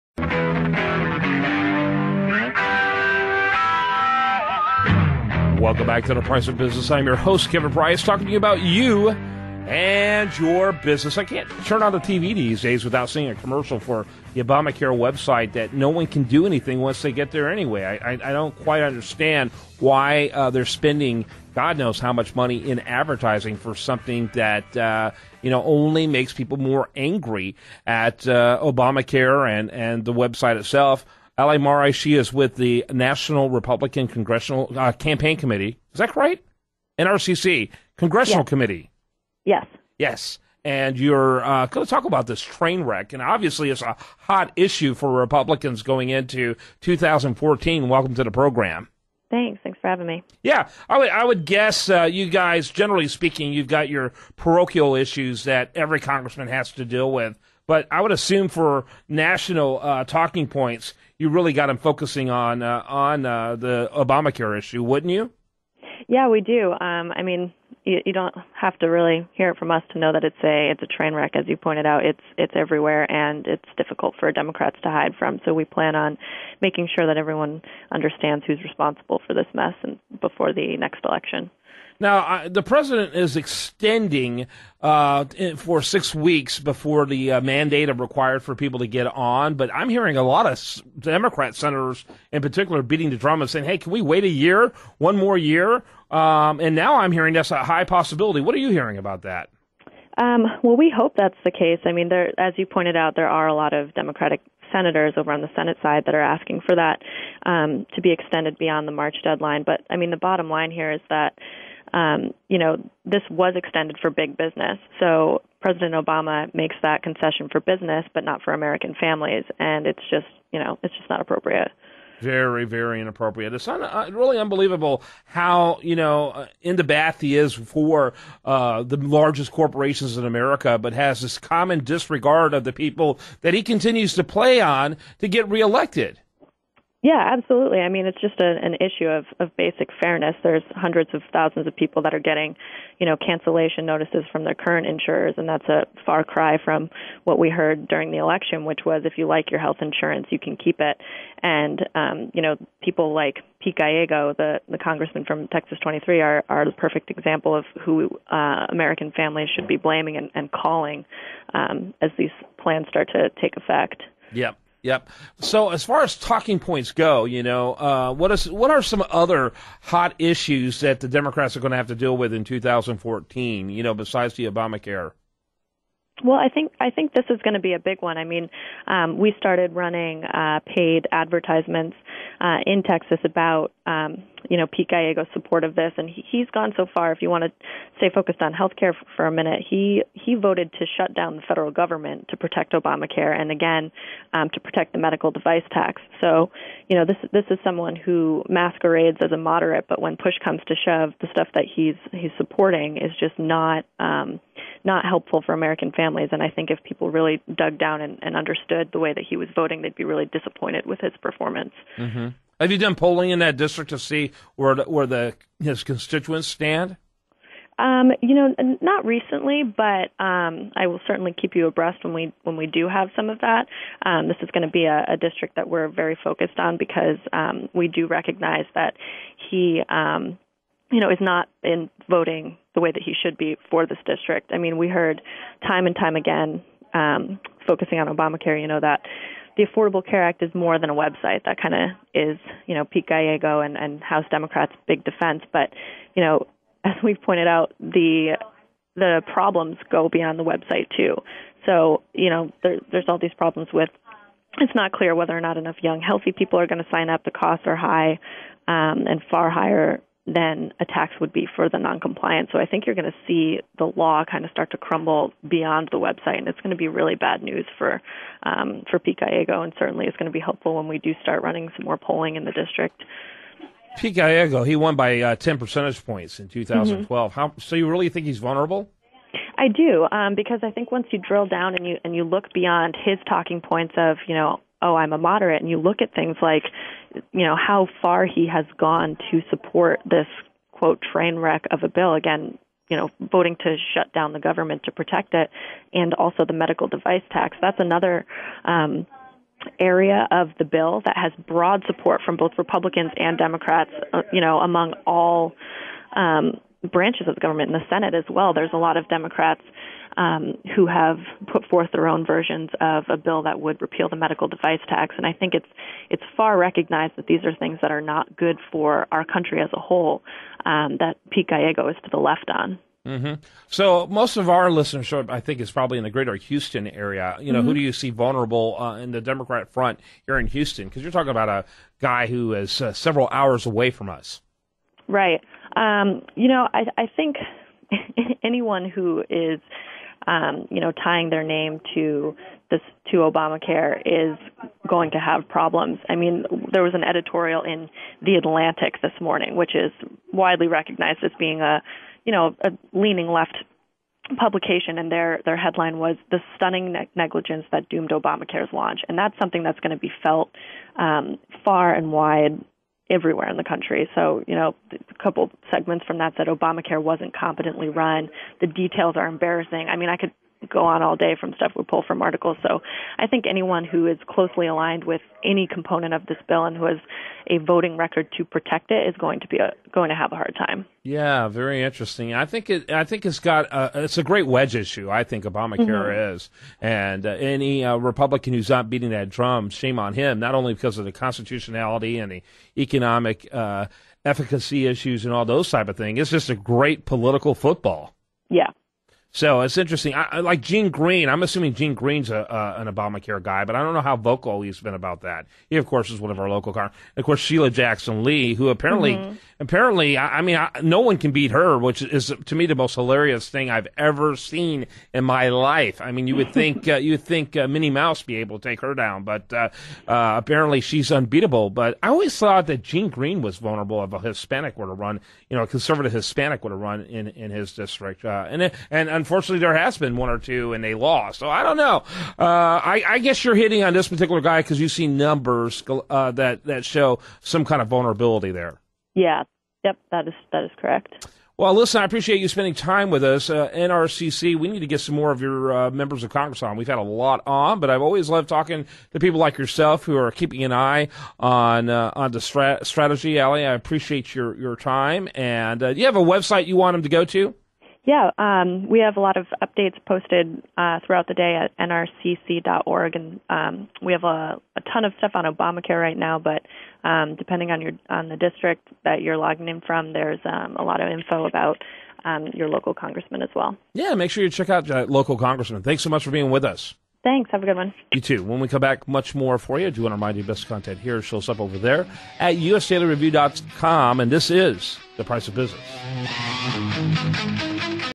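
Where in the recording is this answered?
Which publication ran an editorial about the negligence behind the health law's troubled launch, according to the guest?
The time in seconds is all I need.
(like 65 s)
348 s.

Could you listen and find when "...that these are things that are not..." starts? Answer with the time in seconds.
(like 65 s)
317 s.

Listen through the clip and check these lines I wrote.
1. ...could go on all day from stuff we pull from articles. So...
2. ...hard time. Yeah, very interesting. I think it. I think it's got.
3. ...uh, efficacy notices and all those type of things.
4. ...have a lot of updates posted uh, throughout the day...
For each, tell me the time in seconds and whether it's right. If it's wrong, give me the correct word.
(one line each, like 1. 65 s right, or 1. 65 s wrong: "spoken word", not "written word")
1. 370 s right
2. 380 s right
3. 393 s wrong: "issues", not "notices"
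4. 459 s right.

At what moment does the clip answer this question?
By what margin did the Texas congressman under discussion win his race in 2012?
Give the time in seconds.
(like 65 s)
275 s.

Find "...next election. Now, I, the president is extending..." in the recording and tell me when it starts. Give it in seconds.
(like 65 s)
80 s.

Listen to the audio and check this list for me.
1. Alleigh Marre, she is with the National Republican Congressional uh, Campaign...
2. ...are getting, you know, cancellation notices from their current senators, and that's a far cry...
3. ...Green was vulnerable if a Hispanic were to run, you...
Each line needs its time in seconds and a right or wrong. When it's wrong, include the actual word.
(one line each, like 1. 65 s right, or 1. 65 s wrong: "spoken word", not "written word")
1. 31 s right
2. 142 s wrong: "insurers", not "senators"
3. 423 s right.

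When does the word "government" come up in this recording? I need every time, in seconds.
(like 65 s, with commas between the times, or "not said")
191 s, 294 s, 307 s.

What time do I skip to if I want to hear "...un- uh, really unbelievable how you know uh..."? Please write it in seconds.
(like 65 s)
123 s.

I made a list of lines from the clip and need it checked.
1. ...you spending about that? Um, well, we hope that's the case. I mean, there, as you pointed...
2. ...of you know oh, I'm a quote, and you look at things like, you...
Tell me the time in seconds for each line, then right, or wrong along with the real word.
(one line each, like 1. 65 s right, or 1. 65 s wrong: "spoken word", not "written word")
1. 98 s wrong: "hearing", not "spending"
2. 283 s wrong: "moderate", not "quote".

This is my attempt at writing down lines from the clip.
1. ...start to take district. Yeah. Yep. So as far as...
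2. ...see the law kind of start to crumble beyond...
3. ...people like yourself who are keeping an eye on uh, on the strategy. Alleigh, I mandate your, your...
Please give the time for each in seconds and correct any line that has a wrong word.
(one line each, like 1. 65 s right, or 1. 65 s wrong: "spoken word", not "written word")
1. 162 s wrong: "effect", not "district"
2. 263 s right
3. 449 s wrong: "appreciate", not "mandate".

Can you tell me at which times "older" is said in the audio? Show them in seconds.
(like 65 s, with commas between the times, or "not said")
not said.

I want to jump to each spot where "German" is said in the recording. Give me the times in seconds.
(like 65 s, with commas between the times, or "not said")
not said.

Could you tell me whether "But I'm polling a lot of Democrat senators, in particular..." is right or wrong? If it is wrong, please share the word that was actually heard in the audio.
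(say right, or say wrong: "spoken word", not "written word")
wrong: "hearing", not "polling".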